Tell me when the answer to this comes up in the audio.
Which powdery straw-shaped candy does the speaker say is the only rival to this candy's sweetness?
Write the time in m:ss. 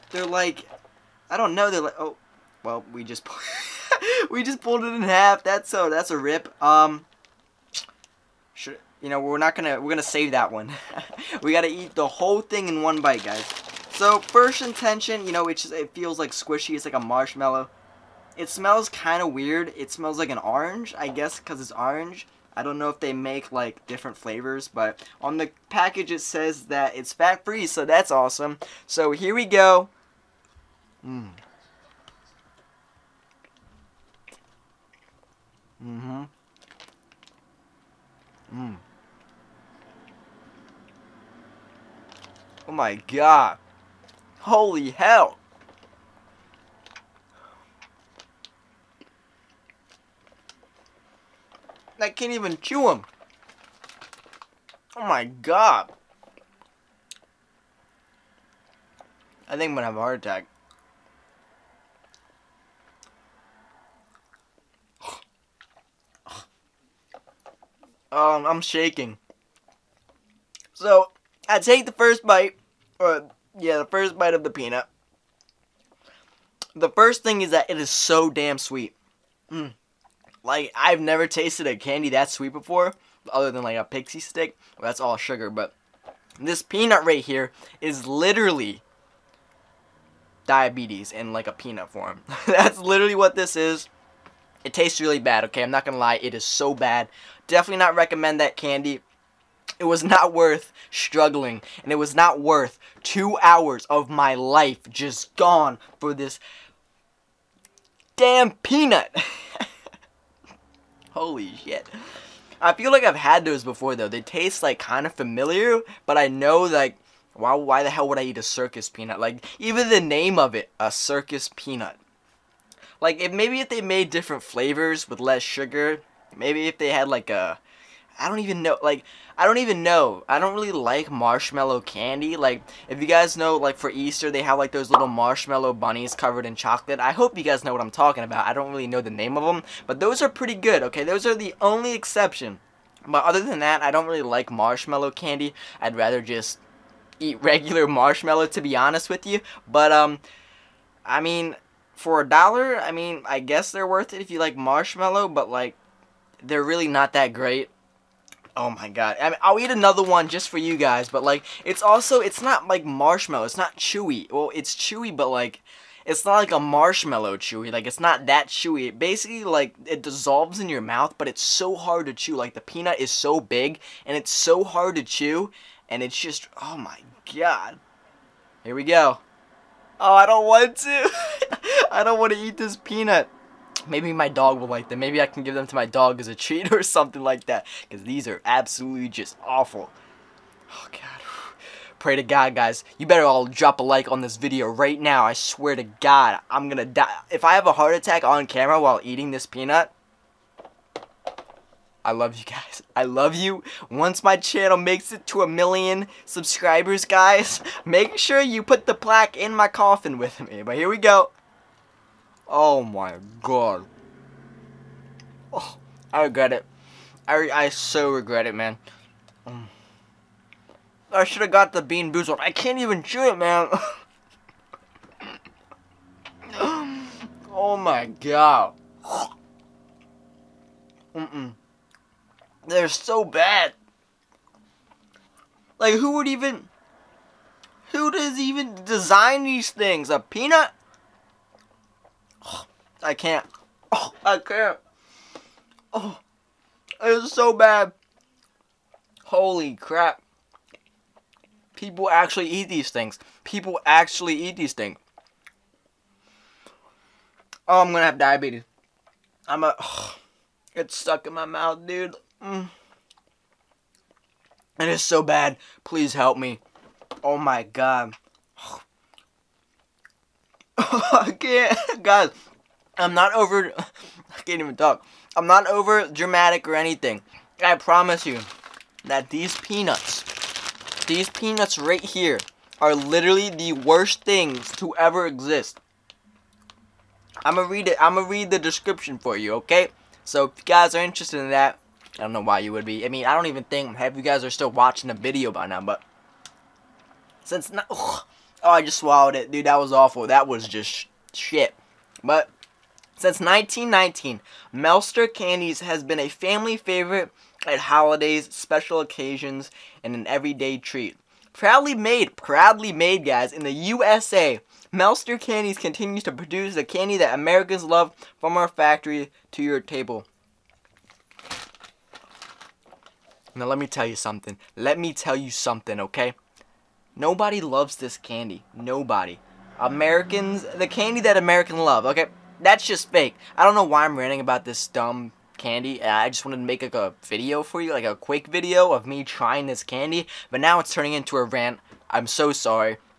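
1:23.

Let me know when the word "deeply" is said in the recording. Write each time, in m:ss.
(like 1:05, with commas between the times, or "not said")
not said.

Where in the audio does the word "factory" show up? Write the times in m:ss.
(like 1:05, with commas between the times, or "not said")
5:18.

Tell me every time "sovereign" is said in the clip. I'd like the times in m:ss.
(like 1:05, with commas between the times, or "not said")
not said.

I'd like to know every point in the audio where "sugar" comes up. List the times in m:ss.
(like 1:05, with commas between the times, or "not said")
1:25, 2:05.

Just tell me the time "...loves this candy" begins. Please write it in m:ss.
5:27.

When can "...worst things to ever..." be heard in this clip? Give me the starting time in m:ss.
4:43.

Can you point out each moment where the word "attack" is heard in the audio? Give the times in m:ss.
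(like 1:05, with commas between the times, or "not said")
1:00, 3:17.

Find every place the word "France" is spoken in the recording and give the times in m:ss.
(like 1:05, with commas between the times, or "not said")
not said.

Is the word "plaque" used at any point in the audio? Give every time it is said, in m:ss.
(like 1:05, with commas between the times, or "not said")
3:28.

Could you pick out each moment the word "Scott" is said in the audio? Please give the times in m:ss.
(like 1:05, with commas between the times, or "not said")
not said.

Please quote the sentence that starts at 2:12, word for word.
Like, if you guys know, like, for Easter, they have, like, those little marshmallow bunnies covered in chocolate.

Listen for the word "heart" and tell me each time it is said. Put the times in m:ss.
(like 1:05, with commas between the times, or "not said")
0:59, 3:17.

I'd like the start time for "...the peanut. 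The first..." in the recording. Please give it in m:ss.
1:14.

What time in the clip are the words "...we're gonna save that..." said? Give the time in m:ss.
0:09.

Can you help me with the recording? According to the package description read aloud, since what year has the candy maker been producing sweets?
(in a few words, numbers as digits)
1919.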